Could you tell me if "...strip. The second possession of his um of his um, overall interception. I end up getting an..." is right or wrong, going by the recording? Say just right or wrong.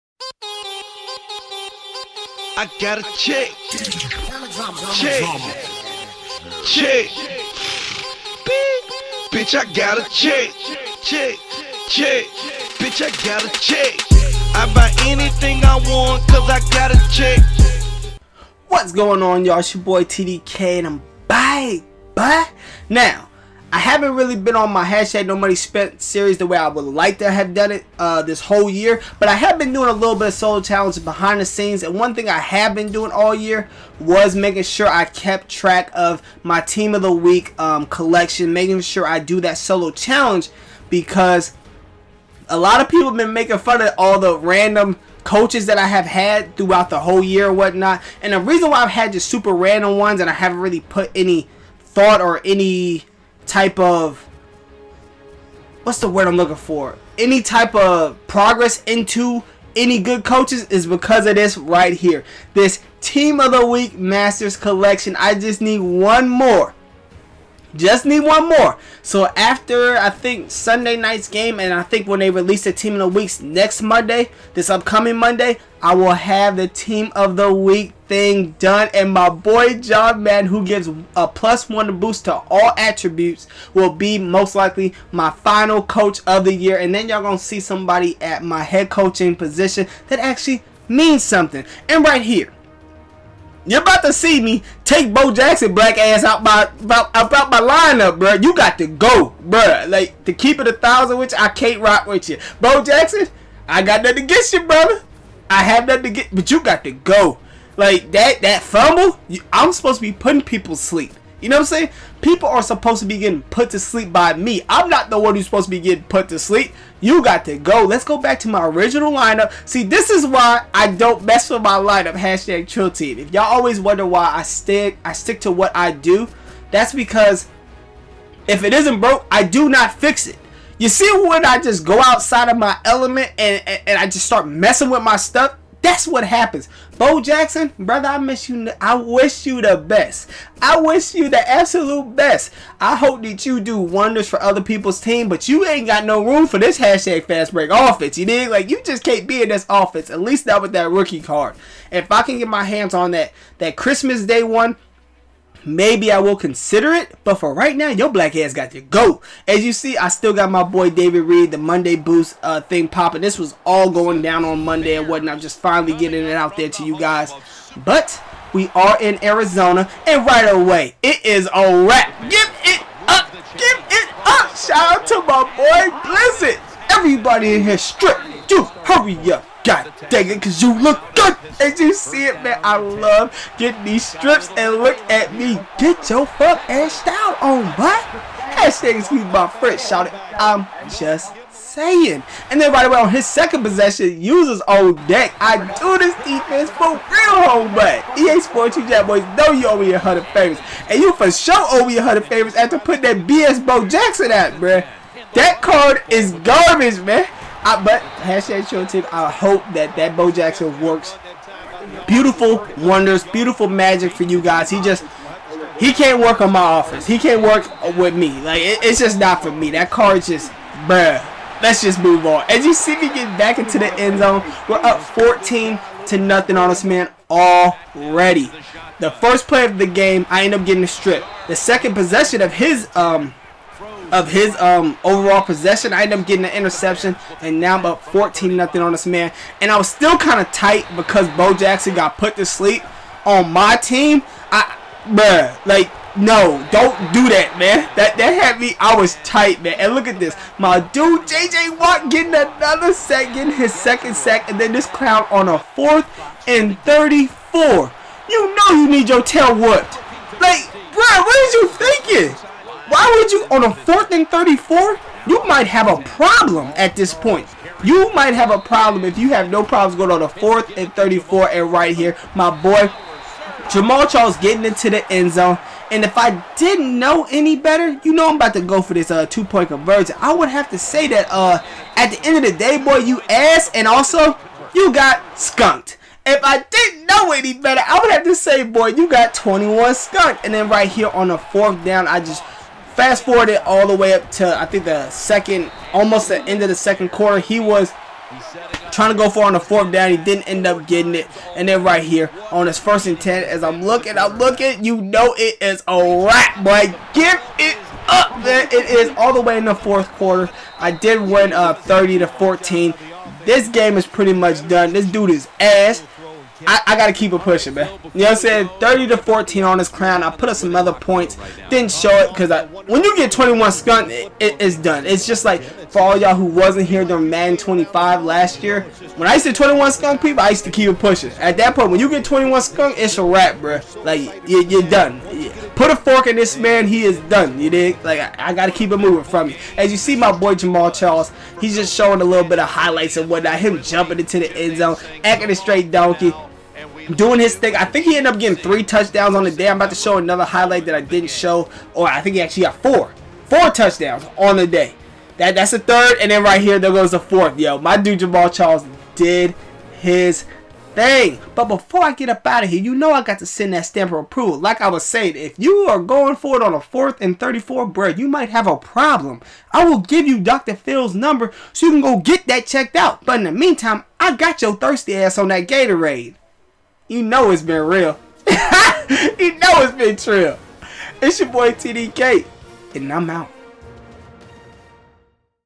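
wrong.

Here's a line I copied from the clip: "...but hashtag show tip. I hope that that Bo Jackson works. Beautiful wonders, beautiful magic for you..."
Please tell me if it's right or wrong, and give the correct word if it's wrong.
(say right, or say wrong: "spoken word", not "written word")
right.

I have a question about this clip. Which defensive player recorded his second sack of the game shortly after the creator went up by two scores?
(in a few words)
J.J. Watt.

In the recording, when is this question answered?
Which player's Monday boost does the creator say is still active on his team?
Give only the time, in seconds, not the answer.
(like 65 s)
160 s.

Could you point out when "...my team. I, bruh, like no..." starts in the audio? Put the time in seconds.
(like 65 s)
243 s.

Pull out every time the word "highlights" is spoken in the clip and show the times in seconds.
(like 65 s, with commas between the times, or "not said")
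342 s, 350 s.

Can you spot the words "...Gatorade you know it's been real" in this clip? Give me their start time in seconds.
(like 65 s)
375 s.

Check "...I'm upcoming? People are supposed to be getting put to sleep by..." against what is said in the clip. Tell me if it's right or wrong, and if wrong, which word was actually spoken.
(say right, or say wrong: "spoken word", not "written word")
wrong: "saying", not "upcoming".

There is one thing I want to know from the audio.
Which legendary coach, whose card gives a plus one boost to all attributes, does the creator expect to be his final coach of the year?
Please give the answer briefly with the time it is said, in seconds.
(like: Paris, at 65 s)
John Madden, at 79 s.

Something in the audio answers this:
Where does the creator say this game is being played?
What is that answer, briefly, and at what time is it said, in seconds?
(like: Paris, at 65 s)
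Arizona, at 169 s.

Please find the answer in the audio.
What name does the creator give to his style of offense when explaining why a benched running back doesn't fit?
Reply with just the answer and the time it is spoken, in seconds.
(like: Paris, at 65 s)
fast break offense, at 147 s.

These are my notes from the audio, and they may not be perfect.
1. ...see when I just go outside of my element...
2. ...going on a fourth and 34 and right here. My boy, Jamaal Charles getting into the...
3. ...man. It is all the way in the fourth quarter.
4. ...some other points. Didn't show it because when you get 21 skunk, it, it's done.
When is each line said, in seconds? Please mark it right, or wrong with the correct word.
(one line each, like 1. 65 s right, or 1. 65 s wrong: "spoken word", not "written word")
1. 130 s right
2. 269 s right
3. 308 s right
4. 320 s right.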